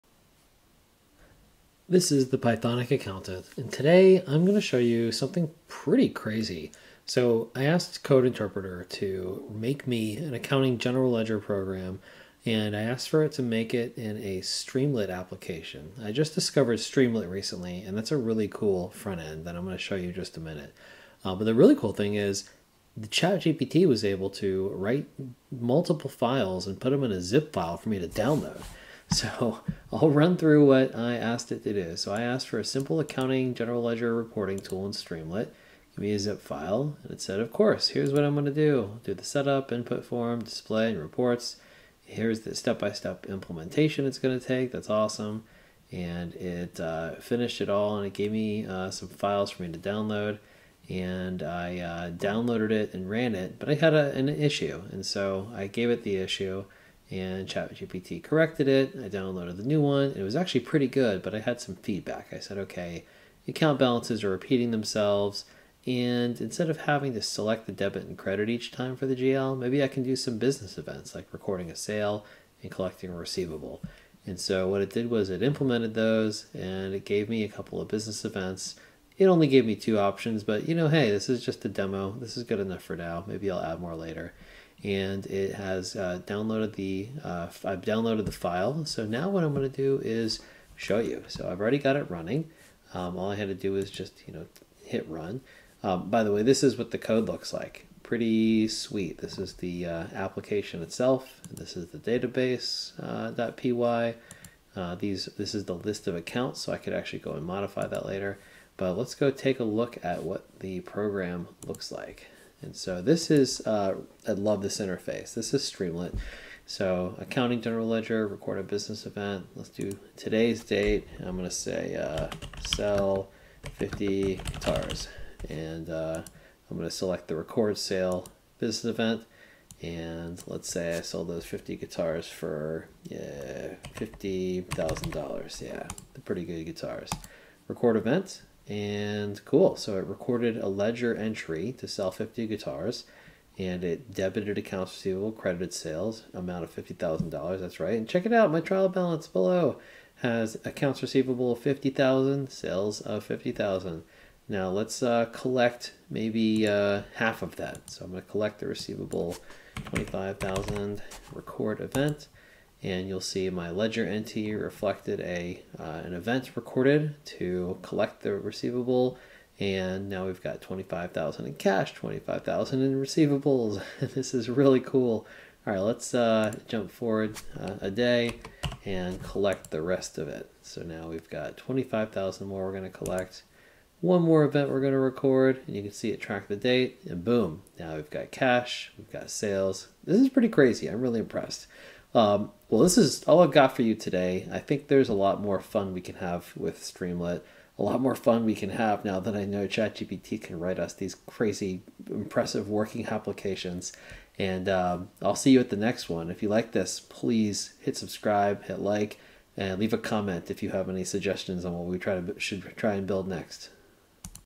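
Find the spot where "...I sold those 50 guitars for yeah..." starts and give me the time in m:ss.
2:10.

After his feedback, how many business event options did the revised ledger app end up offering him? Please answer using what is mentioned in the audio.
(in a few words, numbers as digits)
2.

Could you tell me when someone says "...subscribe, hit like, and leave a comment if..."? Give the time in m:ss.
3:27.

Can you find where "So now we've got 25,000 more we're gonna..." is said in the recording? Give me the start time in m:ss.
3:00.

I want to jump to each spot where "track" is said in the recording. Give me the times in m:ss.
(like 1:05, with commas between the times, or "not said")
3:06.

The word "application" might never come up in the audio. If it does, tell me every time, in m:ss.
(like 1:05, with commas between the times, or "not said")
0:15, 1:40, 3:23.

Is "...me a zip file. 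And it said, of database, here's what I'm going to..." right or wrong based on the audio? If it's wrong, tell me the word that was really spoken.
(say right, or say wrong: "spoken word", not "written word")
wrong: "course", not "database".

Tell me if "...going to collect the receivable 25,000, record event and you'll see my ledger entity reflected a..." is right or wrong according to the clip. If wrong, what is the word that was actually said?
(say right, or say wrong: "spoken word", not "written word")
right.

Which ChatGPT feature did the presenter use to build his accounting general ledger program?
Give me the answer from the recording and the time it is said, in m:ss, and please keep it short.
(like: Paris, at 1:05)
Code Interpreter, at 0:08.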